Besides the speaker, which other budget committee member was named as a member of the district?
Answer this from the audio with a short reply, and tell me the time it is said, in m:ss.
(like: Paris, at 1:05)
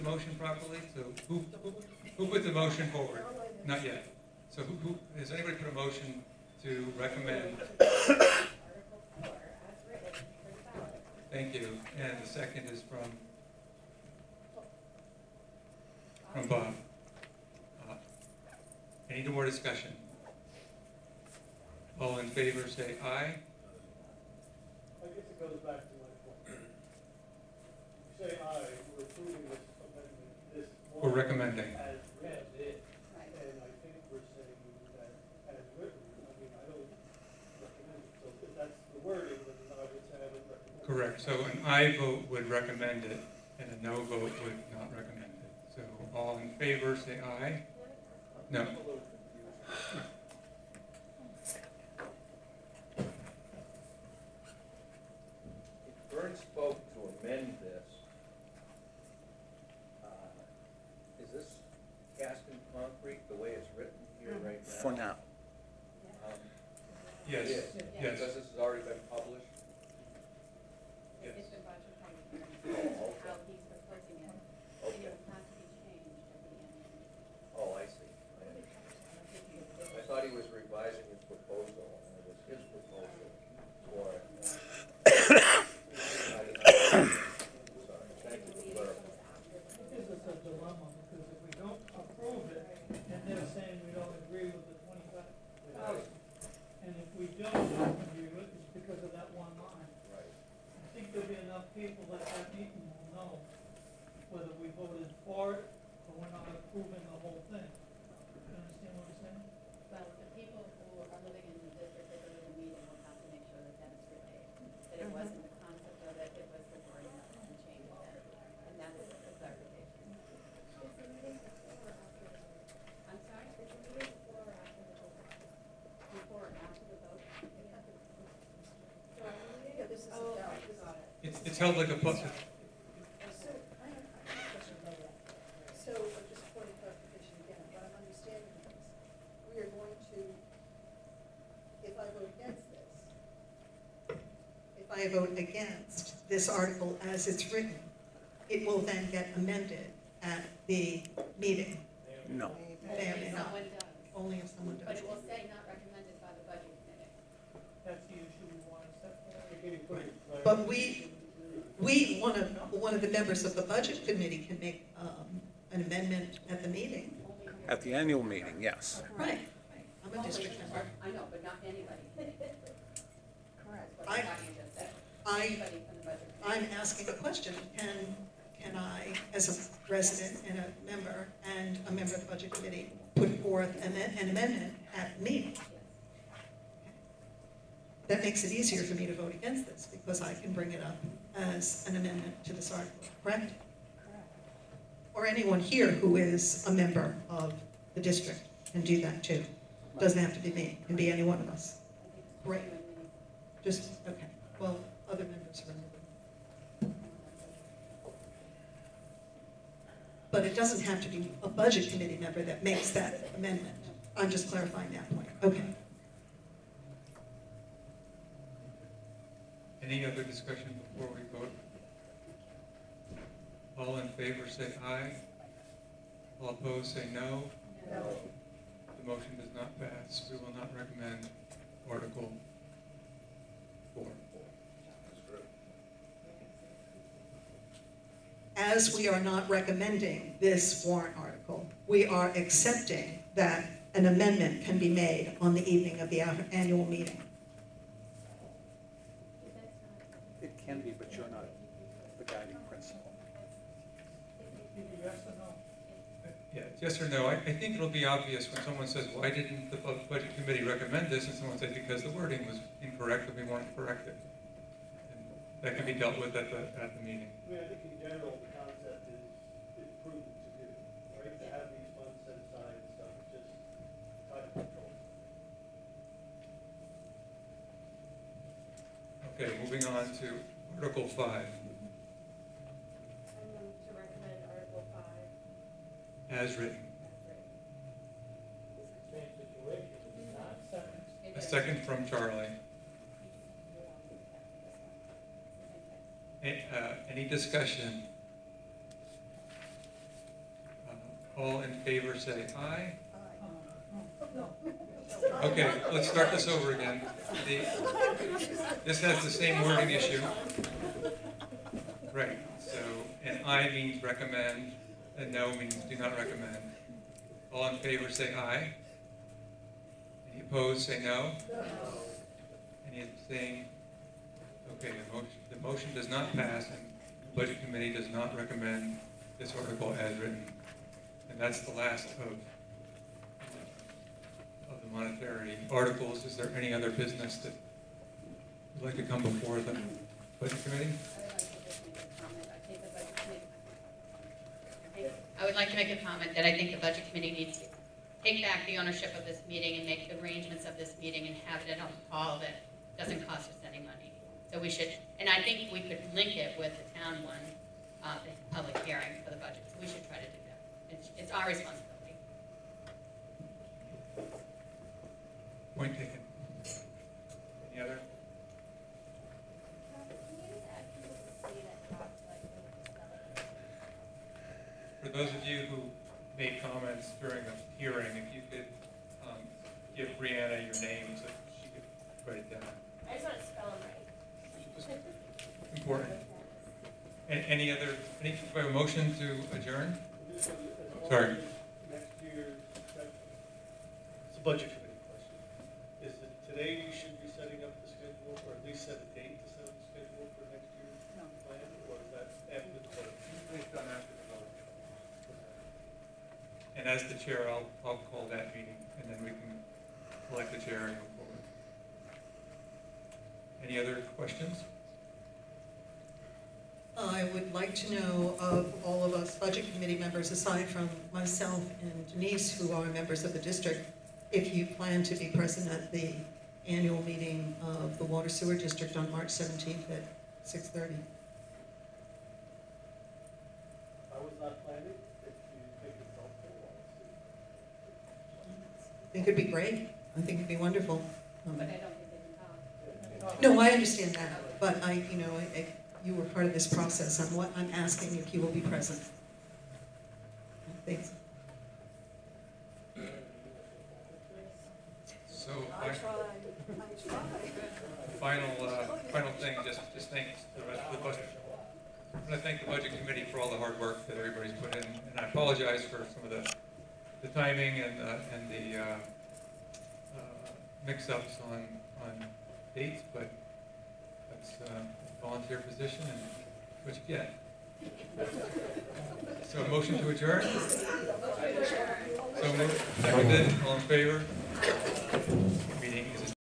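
Denise, at 7:02.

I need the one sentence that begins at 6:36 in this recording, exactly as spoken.
Is it today you should be setting up the schedule or at least set a date?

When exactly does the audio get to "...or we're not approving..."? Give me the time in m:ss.
1:46.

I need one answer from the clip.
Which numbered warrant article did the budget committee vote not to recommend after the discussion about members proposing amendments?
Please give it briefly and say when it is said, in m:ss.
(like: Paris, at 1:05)
Article 4, at 3:51.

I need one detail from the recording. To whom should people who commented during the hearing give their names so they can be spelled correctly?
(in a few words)
Brianna.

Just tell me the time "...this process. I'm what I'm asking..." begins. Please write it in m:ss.
7:26.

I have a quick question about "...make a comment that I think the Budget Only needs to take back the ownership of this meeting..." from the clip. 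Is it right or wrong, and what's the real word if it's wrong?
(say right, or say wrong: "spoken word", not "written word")
wrong: "Committee", not "Only".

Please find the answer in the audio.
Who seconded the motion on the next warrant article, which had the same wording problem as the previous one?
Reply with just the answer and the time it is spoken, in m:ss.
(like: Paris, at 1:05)
Charlie, at 4:52.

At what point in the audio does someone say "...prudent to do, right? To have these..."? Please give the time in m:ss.
4:30.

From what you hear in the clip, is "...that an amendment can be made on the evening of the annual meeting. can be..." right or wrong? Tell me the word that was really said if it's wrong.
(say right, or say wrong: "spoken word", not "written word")
right.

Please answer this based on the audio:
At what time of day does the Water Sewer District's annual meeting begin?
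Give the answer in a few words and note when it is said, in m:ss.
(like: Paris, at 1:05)
6:30, at 7:10.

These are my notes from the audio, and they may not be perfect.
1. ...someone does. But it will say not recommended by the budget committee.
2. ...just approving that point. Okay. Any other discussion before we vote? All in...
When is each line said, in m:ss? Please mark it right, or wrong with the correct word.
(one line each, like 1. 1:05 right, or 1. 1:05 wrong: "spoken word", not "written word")
1. 2:34 right
2. 3:34 wrong: "clarifying", not "approving".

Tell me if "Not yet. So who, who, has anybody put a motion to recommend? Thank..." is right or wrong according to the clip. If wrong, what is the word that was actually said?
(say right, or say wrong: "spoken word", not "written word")
right.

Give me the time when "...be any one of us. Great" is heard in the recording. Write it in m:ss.
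3:20.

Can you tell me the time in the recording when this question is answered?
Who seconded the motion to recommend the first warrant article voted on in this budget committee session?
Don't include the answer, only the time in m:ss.
0:16.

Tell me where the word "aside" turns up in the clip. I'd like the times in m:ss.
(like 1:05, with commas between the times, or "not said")
4:32, 7:00.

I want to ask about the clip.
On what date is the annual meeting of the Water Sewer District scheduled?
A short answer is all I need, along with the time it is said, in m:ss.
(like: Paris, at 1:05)
March 17th, at 7:09.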